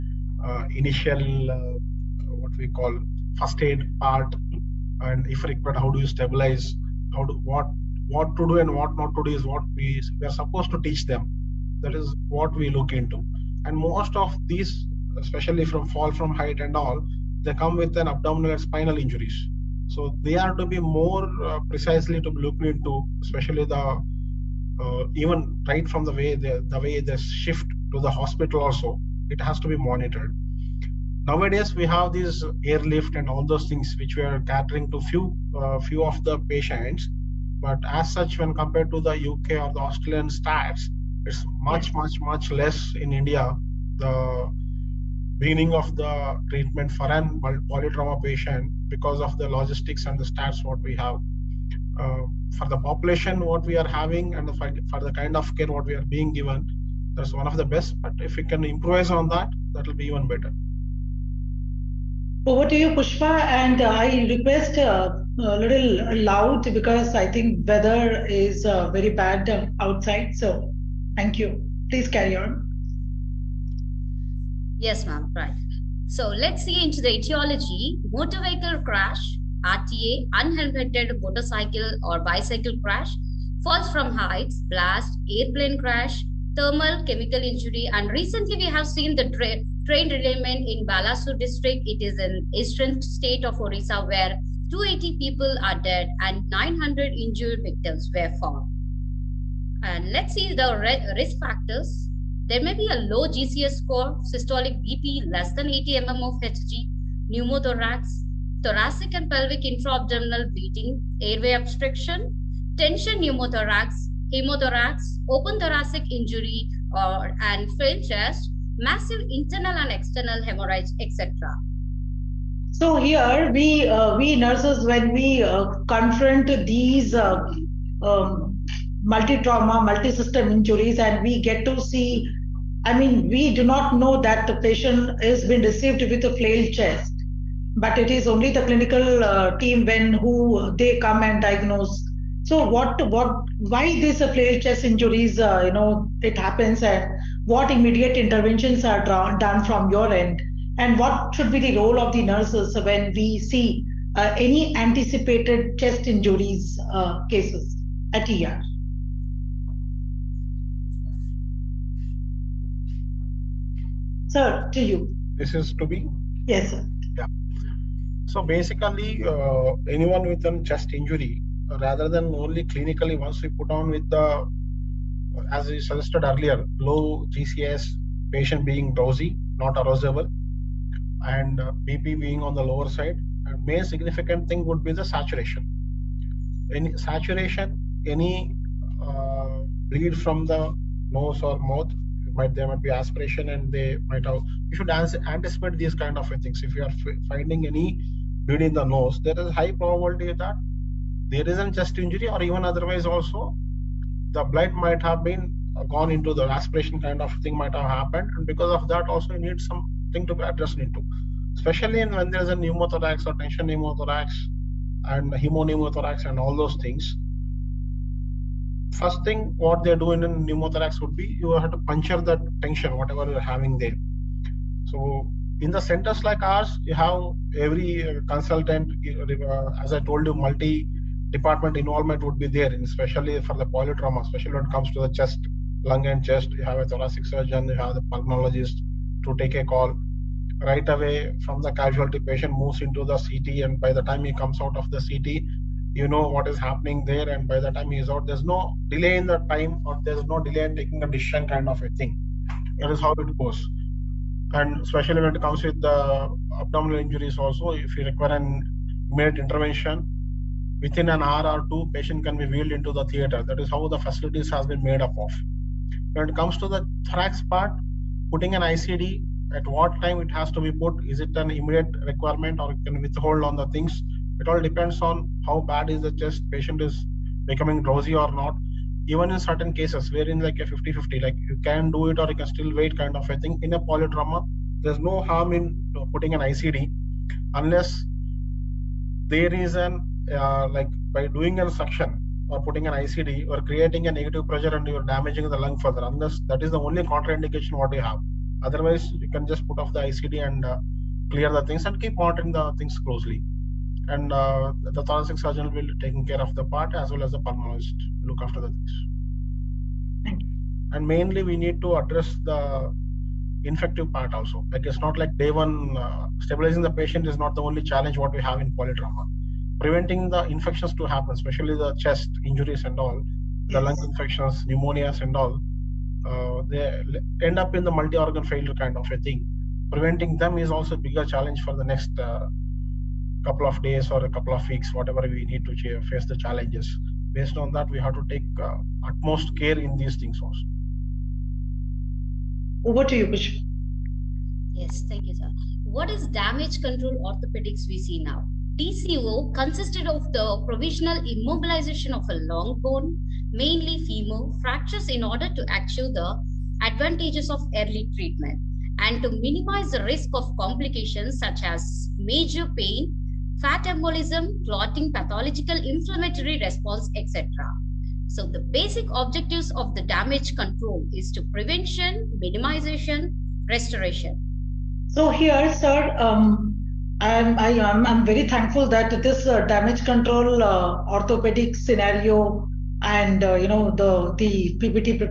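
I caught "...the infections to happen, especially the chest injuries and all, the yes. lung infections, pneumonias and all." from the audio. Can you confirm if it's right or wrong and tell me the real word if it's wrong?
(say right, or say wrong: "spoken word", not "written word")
right.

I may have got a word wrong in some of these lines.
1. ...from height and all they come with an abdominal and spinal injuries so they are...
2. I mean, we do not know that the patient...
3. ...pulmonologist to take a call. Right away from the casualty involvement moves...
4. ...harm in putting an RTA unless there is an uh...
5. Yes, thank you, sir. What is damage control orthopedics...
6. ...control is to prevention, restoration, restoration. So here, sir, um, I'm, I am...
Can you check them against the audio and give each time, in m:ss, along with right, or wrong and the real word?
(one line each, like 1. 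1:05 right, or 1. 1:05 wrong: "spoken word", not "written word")
1. 0:16 right
2. 2:12 right
3. 3:58 wrong: "patient", not "involvement"
4. 4:45 wrong: "ICD", not "RTA"
5. 5:44 right
6. 6:10 wrong: "minimization", not "restoration".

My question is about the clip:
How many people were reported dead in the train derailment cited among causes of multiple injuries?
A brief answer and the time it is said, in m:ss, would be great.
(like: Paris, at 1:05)
280, at 1:34.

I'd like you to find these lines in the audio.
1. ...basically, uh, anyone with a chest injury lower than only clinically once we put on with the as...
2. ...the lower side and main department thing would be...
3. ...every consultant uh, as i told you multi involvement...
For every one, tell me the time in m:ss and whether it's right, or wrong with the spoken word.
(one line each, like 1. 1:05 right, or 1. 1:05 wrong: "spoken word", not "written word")
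1. 2:48 wrong: "rather", not "lower"
2. 3:02 wrong: "significant", not "department"
3. 3:47 wrong: "department", not "involvement".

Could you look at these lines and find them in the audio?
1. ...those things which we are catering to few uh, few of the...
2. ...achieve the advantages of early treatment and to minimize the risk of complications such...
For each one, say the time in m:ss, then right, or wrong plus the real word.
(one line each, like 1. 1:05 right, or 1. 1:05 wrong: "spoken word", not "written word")
1. 0:33 right
2. 5:55 right.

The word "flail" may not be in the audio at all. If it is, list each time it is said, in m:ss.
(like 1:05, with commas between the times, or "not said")
1:57, 2:16, 2:24.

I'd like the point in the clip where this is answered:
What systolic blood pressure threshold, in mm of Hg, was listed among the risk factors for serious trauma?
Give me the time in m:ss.
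1:45.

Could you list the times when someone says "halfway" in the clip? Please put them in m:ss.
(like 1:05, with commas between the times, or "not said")
not said.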